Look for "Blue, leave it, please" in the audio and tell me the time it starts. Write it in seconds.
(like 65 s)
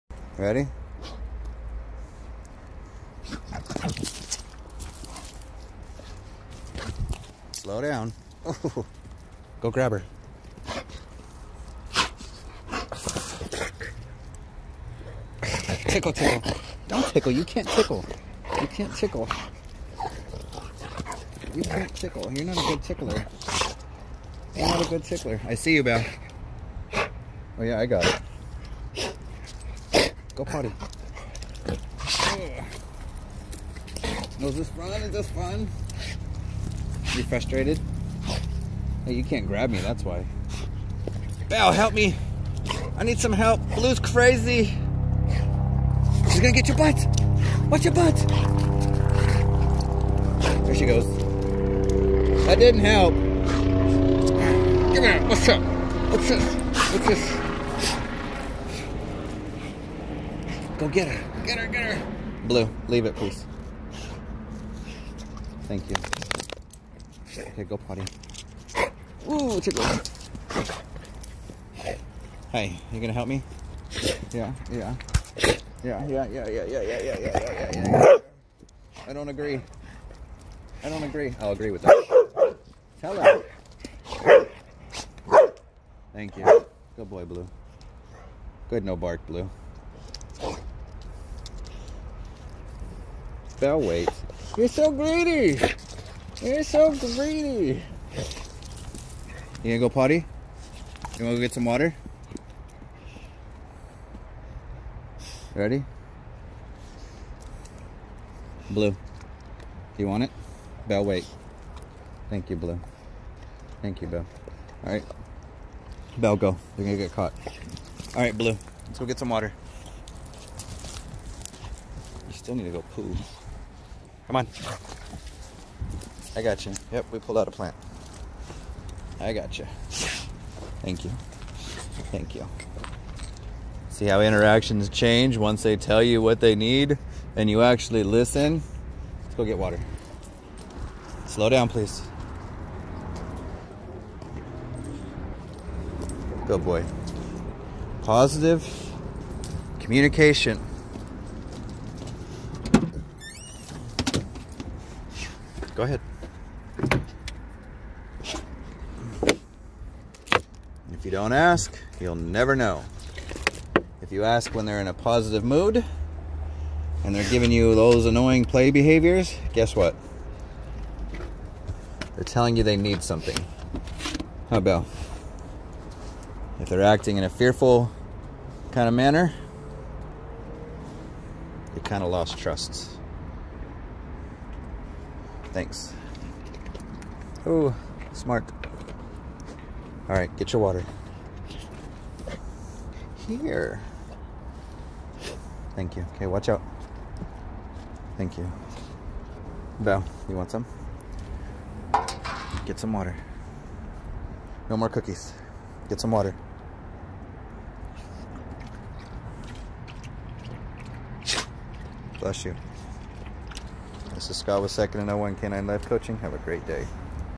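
62 s.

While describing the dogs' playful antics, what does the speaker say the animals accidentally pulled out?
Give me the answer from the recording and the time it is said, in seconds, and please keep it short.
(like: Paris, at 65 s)
A plant, at 127 s.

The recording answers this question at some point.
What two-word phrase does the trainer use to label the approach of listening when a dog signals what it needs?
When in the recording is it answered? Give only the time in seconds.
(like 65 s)
148 s.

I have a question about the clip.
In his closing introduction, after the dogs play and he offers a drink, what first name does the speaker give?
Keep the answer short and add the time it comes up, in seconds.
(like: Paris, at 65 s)
Scott, at 214 s.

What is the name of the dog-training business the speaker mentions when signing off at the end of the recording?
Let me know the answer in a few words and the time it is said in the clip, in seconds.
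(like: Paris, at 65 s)
Second to No One Canine Life Coaching, at 214 s.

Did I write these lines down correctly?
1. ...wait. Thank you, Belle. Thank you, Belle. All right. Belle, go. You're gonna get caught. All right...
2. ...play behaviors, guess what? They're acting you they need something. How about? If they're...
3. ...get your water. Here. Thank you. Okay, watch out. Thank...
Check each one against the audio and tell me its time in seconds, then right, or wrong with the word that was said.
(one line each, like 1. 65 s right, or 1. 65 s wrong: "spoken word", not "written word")
1. 111 s wrong: "Blue", not "Belle"
2. 168 s wrong: "telling", not "acting"
3. 190 s right.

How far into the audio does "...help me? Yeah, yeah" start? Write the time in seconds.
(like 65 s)
73 s.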